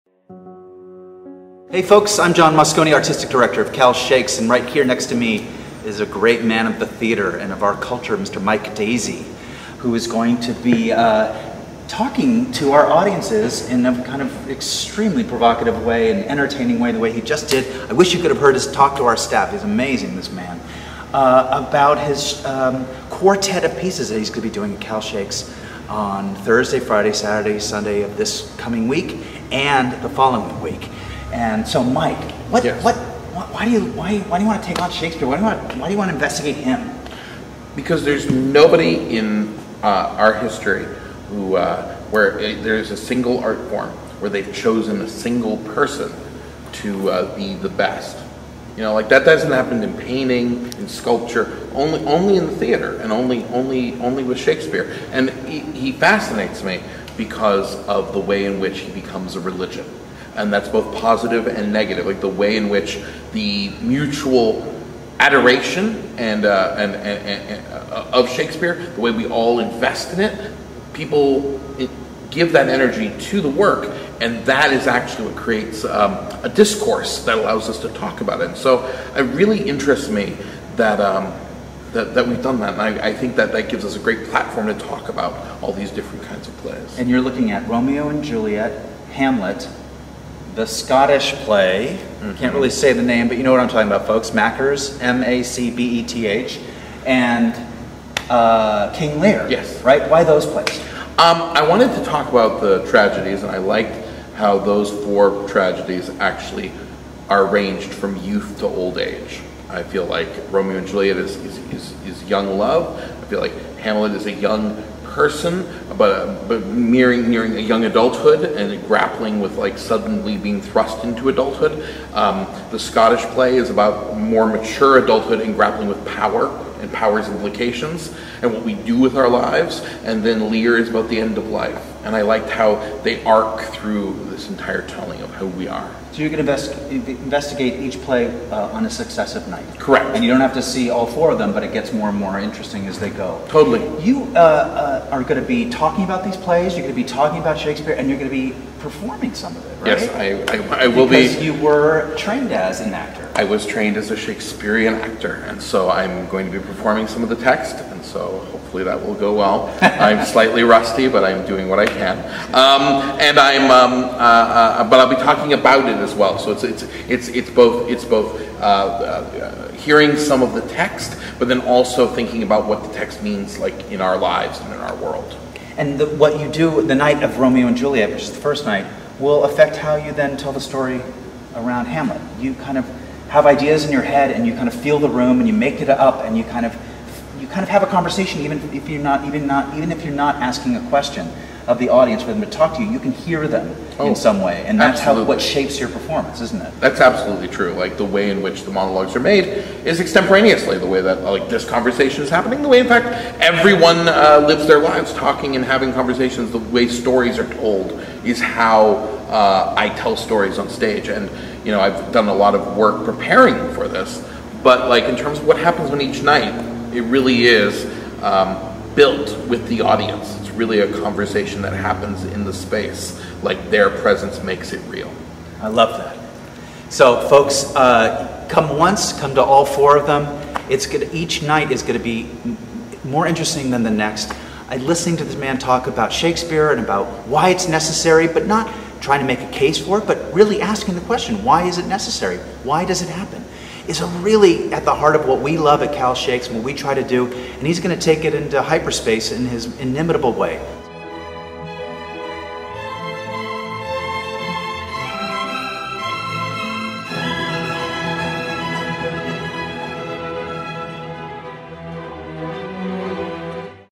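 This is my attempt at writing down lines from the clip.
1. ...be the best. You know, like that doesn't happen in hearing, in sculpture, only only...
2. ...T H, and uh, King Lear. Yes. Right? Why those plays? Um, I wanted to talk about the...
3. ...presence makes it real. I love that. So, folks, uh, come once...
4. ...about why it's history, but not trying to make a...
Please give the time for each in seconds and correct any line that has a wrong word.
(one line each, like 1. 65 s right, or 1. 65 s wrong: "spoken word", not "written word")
1. 47 s wrong: "painting", not "hearing"
2. 96 s right
3. 223 s right
4. 236 s wrong: "necessary", not "history".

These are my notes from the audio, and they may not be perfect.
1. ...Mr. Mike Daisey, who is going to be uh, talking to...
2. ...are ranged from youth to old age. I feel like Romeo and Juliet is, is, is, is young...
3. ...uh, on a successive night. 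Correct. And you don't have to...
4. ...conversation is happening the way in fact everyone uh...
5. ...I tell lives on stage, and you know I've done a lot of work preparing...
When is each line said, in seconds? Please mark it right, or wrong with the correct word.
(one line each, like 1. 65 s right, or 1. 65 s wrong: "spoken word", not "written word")
1. 8 s right
2. 107 s right
3. 138 s right
4. 201 s right
5. 209 s wrong: "stories", not "lives".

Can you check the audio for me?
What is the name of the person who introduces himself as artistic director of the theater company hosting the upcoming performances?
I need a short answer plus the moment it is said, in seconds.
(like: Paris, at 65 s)
John Moscone, at 2 s.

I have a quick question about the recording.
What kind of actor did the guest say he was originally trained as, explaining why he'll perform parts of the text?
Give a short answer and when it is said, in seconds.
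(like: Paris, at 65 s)
Shakespearean actor, at 154 s.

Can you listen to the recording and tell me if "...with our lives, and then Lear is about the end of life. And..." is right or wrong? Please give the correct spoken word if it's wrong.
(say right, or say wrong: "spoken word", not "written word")
right.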